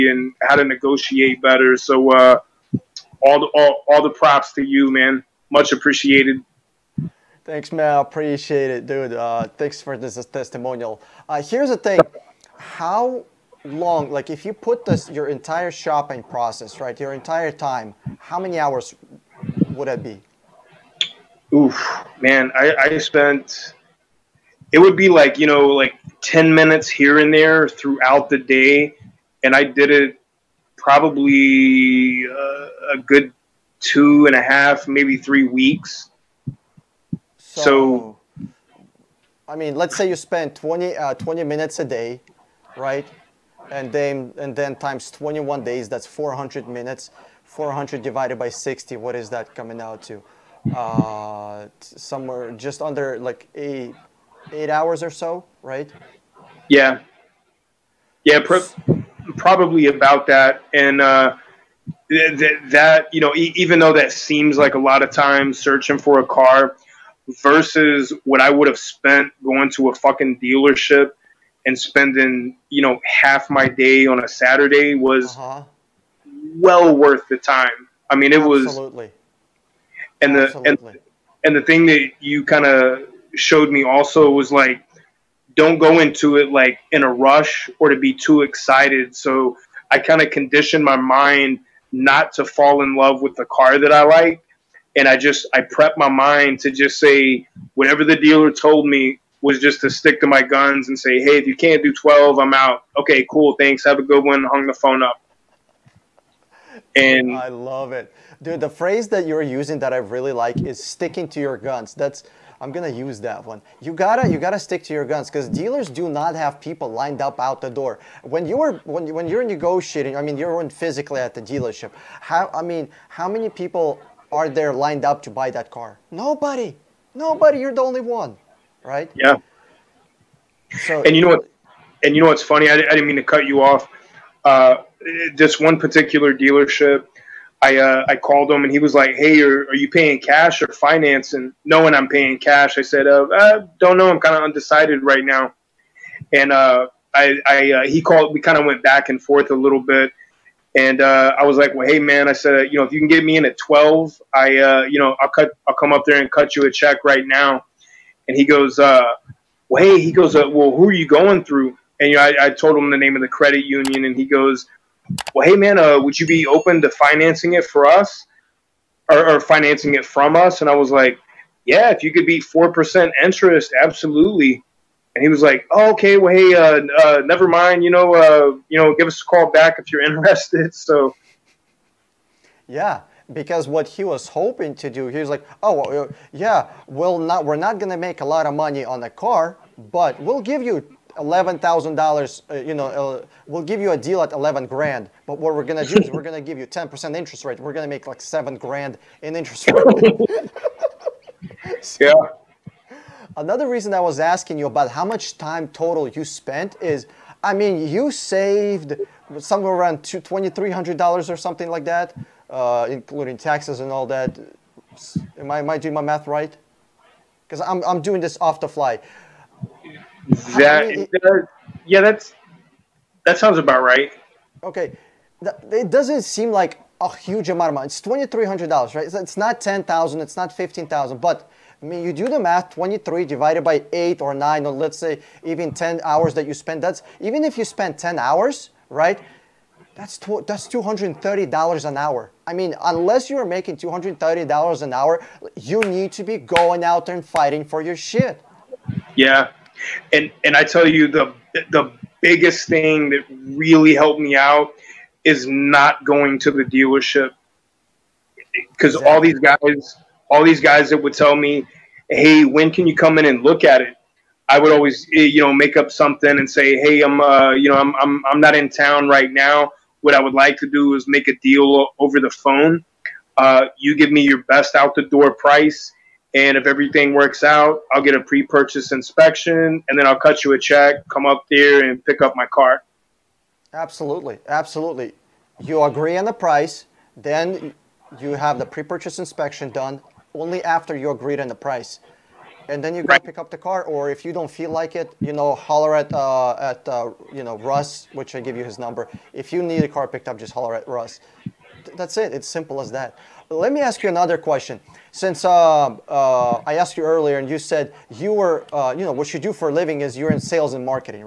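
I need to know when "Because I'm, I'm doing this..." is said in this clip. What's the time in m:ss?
3:37.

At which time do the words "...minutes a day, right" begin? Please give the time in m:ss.
0:41.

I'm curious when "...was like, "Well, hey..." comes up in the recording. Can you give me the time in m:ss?
2:31.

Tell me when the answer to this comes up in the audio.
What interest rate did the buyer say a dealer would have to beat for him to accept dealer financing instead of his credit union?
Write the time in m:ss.
2:52.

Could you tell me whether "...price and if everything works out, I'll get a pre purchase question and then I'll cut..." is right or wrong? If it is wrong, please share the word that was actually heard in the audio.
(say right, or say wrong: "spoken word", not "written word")
wrong: "inspection", not "question".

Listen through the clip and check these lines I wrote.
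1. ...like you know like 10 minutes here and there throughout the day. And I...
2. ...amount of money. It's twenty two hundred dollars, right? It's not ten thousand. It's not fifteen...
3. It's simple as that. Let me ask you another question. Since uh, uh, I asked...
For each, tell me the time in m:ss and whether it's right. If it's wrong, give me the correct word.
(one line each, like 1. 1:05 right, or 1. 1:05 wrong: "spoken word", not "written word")
1. 0:25 right
2. 3:47 wrong: "three", not "two"
3. 5:02 right.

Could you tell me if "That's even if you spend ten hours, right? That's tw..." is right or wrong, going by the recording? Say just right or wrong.
right.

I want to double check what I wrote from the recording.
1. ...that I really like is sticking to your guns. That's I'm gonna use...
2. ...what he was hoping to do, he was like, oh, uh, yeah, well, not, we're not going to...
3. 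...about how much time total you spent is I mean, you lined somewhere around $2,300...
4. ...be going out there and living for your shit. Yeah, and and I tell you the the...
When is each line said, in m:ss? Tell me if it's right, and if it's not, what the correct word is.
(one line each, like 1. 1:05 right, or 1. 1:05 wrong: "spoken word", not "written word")
1. 1:49 right
2. 3:03 right
3. 3:24 wrong: "saved", not "lined"
4. 4:06 wrong: "fighting", not "living".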